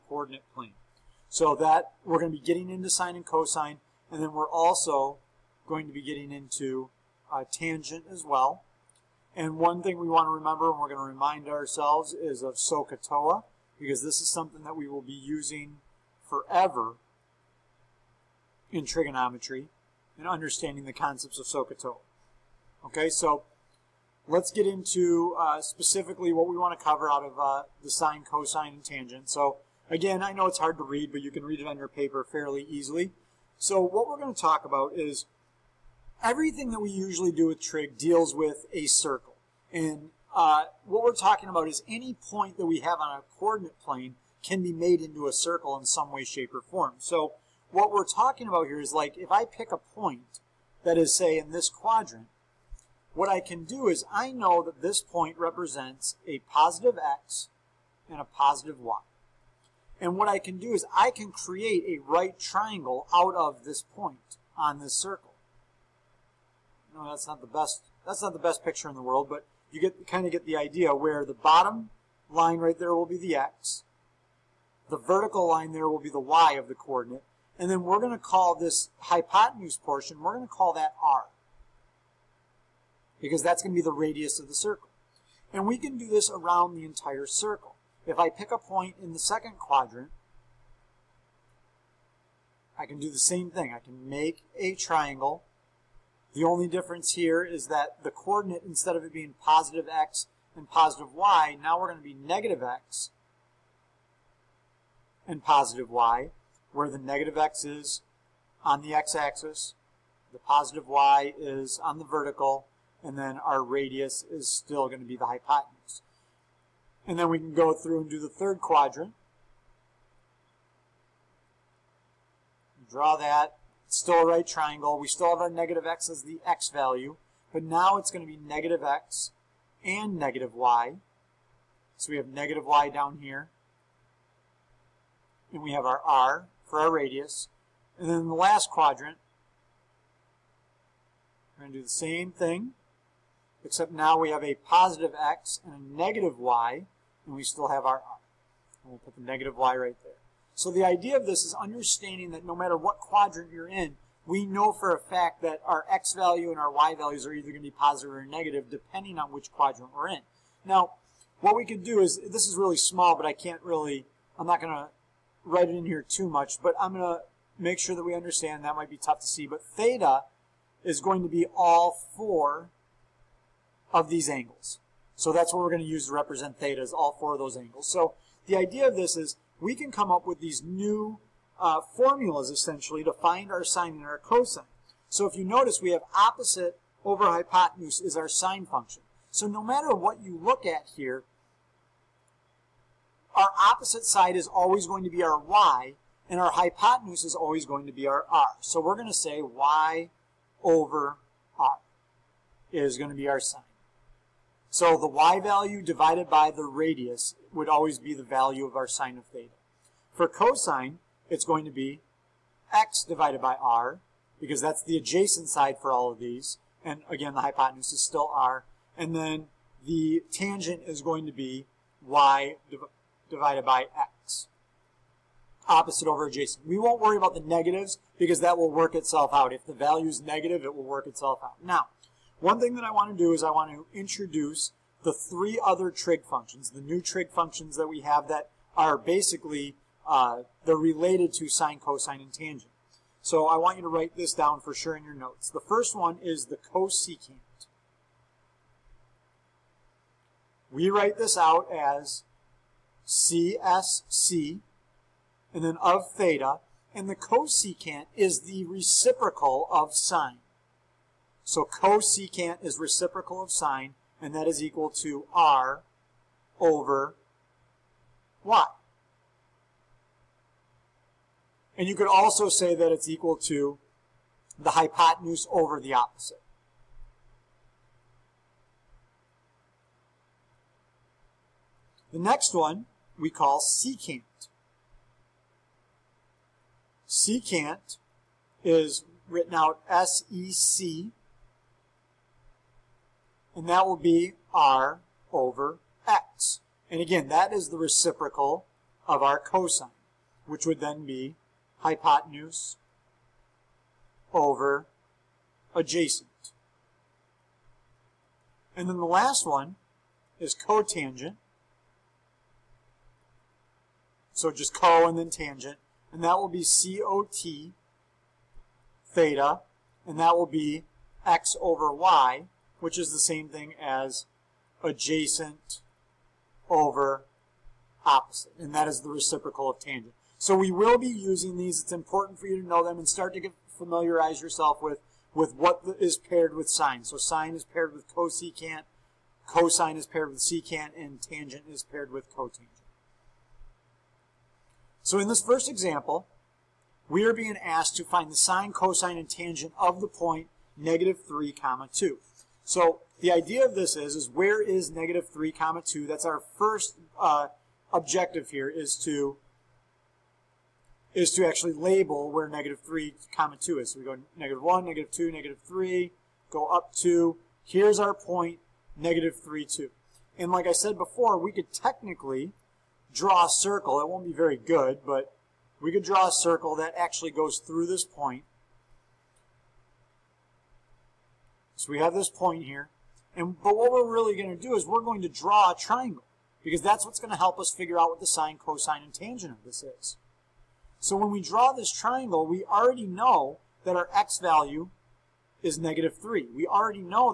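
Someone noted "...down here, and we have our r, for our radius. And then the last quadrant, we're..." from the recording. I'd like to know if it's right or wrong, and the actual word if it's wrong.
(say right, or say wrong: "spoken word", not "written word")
right.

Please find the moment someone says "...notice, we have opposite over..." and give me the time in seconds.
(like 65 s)
185 s.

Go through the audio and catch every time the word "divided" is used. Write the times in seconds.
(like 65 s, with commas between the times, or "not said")
205 s, 213 s, 223 s.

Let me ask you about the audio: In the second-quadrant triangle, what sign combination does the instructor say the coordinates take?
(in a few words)
negative x and positive y.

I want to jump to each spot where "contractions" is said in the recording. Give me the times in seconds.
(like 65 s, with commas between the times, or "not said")
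not said.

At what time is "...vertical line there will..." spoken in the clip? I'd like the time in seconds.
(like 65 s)
74 s.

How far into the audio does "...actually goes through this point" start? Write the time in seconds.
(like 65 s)
376 s.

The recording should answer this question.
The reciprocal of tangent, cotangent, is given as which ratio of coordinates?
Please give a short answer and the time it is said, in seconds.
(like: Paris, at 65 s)
x over y, at 321 s.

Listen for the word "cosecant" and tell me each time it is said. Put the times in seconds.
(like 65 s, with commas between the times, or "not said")
246 s, 257 s, 261 s, 338 s.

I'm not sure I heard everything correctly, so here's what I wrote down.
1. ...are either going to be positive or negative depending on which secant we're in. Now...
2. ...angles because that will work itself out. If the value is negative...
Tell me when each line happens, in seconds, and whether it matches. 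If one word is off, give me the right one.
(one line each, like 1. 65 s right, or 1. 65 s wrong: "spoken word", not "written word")
1. 157 s wrong: "quadrant", not "secant"
2. 227 s wrong: "negatives", not "angles".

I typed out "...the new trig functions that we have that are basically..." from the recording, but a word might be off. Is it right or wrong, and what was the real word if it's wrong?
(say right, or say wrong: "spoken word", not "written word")
right.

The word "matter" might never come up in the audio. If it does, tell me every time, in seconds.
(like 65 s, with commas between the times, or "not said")
152 s, 189 s.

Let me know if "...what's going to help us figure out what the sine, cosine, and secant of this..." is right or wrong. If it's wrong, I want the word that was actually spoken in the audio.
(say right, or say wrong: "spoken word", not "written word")
wrong: "tangent", not "secant".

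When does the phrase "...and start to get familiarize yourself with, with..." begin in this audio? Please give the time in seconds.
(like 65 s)
332 s.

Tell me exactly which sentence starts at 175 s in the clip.
So that's what we're going to use to represent theta is all four of those angles.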